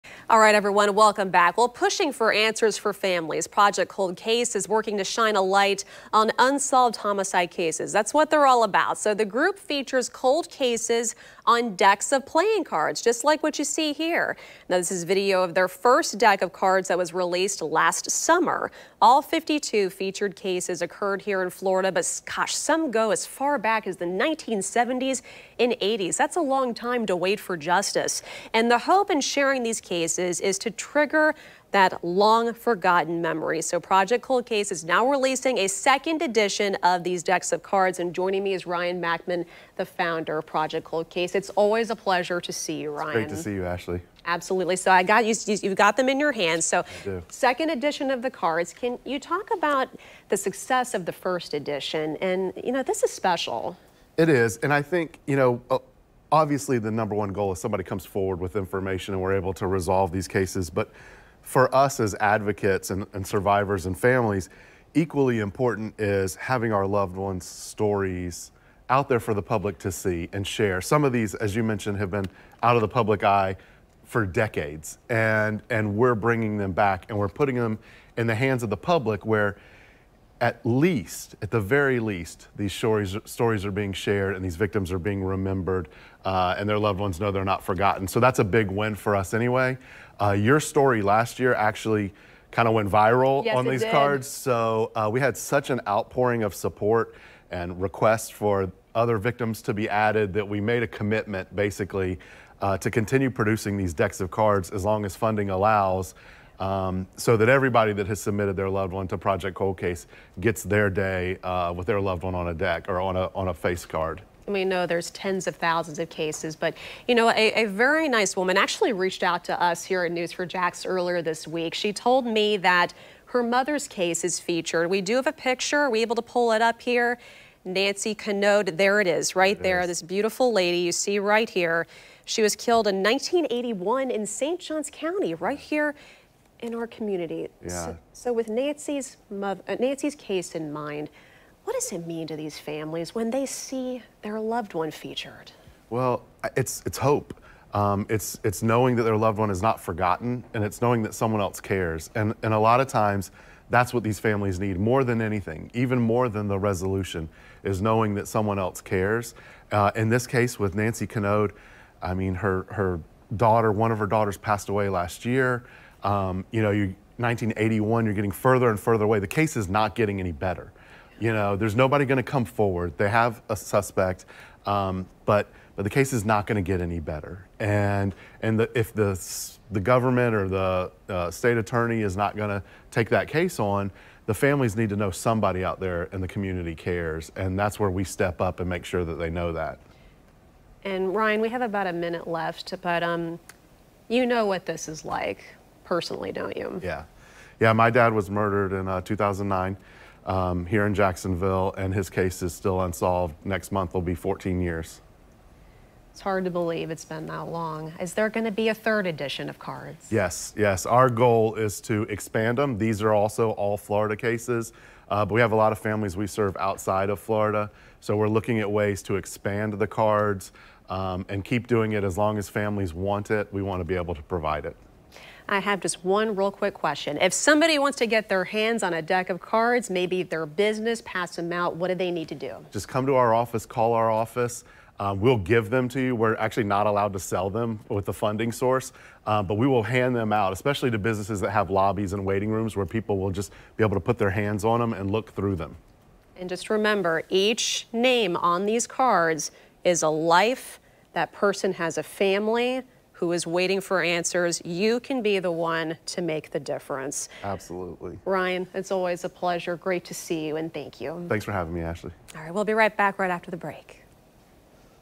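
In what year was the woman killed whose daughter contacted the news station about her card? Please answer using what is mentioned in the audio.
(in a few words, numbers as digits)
1981.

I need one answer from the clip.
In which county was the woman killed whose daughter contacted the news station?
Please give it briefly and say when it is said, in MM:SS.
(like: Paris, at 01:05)
St. Johns County, at 02:14.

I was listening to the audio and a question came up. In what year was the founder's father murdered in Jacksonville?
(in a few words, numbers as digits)
2009.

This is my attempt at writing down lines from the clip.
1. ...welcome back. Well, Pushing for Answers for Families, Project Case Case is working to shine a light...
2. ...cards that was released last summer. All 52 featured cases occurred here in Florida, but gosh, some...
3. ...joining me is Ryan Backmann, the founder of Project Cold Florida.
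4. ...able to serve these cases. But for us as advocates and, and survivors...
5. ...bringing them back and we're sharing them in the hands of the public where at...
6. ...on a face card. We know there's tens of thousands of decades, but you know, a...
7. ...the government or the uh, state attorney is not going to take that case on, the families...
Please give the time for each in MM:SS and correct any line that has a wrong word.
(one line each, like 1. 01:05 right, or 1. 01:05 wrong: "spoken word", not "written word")
1. 00:00 wrong: "Cold", not "Case"
2. 00:16 right
3. 00:38 wrong: "Case", not "Florida"
4. 00:59 wrong: "resolve", not "serve"
5. 01:16 wrong: "putting", not "sharing"
6. 01:53 wrong: "cases", not "decades"
7. 02:59 right.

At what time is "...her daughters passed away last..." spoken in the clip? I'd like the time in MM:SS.
02:43.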